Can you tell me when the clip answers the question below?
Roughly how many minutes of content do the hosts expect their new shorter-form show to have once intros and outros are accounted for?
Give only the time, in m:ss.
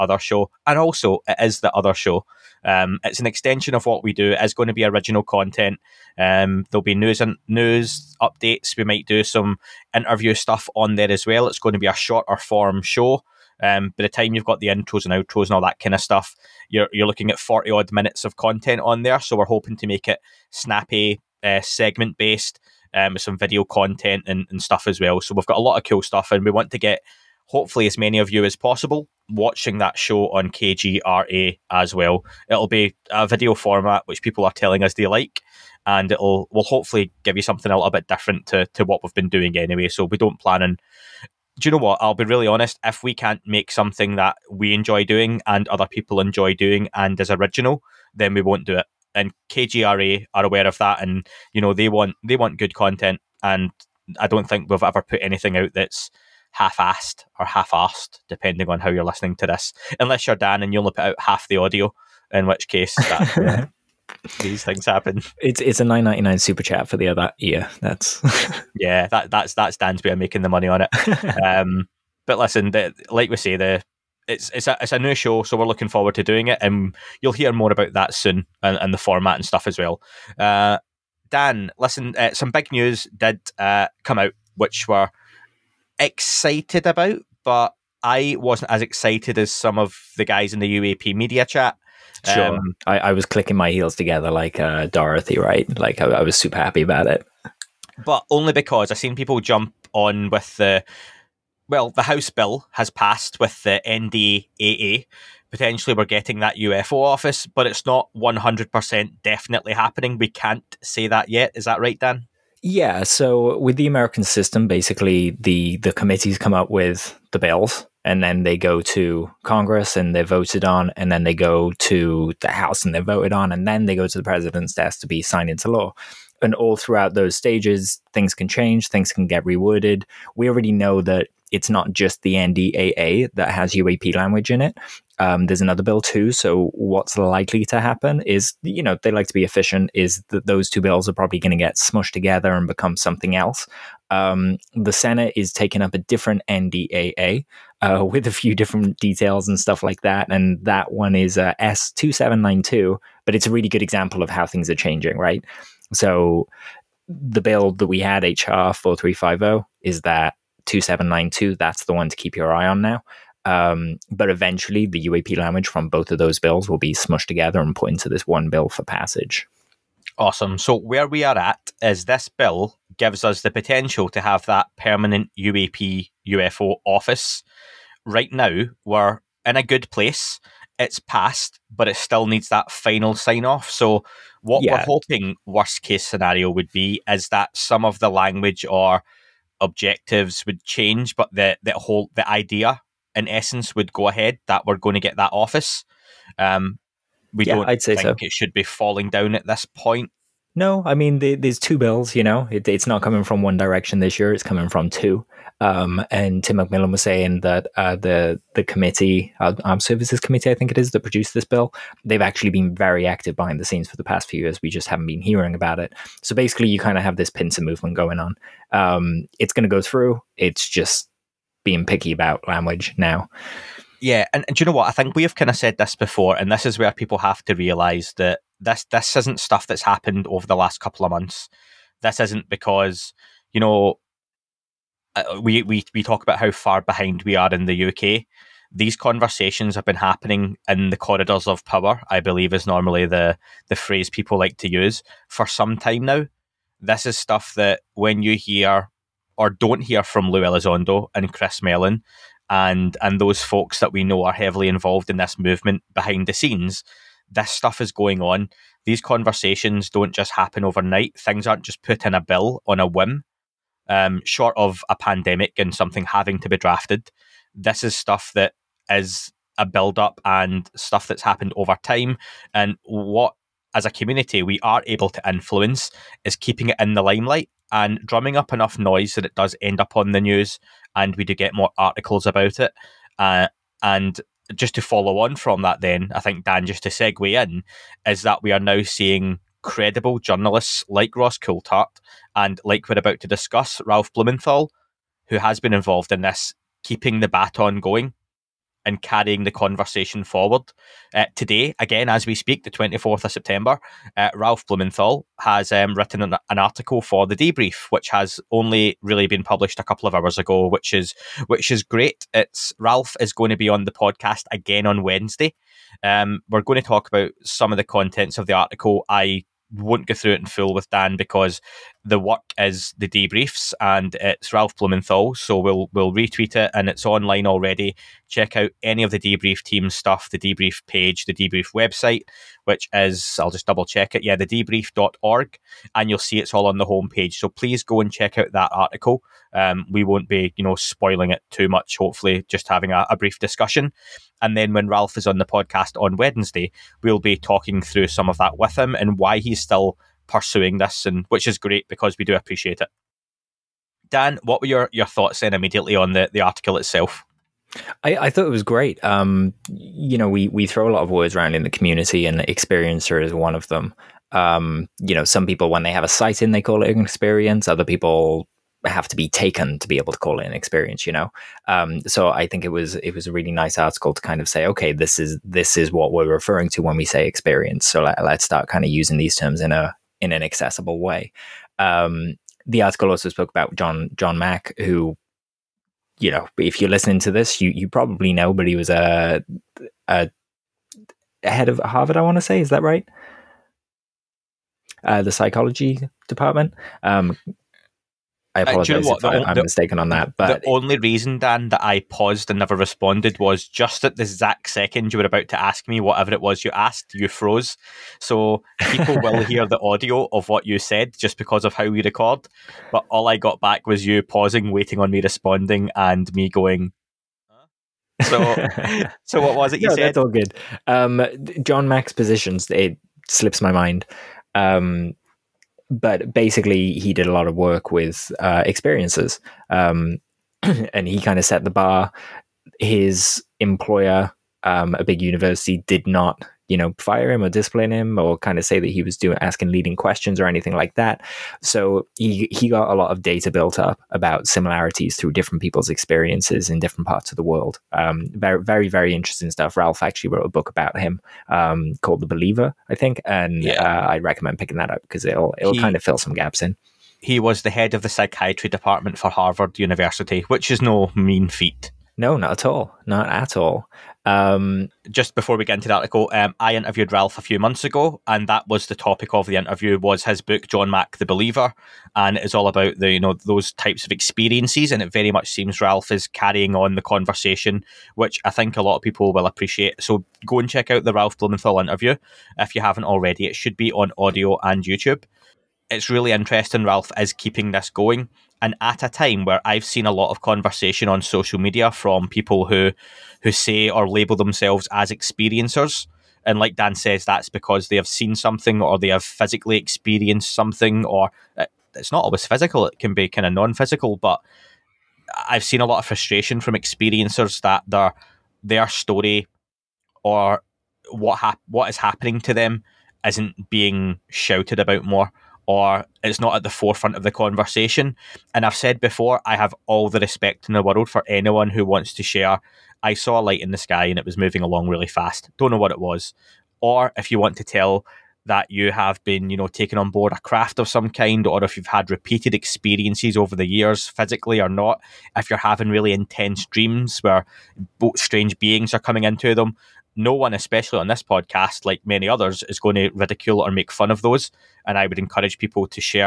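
0:17.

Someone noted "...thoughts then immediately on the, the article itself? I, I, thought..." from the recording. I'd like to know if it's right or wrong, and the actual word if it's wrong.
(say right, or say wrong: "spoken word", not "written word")
right.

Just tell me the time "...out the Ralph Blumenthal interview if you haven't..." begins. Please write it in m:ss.
8:00.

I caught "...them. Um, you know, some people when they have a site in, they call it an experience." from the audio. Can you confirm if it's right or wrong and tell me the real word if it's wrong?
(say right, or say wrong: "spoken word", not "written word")
right.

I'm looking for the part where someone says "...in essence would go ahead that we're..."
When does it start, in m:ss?
3:13.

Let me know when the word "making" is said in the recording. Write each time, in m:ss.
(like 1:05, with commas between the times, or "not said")
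1:10.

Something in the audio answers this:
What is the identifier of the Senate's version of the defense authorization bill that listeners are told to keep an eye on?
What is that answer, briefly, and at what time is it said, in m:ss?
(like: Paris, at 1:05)
S 2792, at 2:31.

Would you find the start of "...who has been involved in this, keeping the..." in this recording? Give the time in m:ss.
4:55.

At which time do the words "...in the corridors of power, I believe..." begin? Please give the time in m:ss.
4:00.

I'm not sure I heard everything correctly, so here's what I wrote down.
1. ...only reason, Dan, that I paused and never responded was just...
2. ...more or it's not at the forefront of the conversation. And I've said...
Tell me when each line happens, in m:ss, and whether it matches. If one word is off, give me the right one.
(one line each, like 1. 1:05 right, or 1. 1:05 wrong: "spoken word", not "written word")
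1. 6:40 right
2. 8:35 right.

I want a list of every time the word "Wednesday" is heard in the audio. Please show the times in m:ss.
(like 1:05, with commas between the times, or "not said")
5:15, 5:46.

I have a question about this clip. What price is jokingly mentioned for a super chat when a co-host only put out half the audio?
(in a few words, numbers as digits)
9.99.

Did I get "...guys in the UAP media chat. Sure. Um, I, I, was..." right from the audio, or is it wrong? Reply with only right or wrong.
right.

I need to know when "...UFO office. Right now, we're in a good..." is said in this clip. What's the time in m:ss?
2:56.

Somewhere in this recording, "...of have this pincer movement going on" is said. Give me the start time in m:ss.
3:36.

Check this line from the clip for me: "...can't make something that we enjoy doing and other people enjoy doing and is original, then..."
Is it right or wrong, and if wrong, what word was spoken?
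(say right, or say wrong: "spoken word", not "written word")
right.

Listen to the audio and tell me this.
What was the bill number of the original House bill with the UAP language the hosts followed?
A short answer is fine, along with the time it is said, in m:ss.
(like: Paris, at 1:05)
HR 4350, at 2:38.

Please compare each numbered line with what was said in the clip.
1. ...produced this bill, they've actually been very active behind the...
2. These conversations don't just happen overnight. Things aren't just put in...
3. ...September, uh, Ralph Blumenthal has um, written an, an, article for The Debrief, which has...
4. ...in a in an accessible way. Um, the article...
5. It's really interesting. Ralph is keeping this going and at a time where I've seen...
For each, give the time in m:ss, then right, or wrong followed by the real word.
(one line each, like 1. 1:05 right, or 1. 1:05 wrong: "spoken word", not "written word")
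1. 3:31 right
2. 4:18 right
3. 5:03 right
4. 6:19 right
5. 8:05 right.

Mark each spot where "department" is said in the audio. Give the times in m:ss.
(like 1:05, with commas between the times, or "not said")
6:36, 7:38.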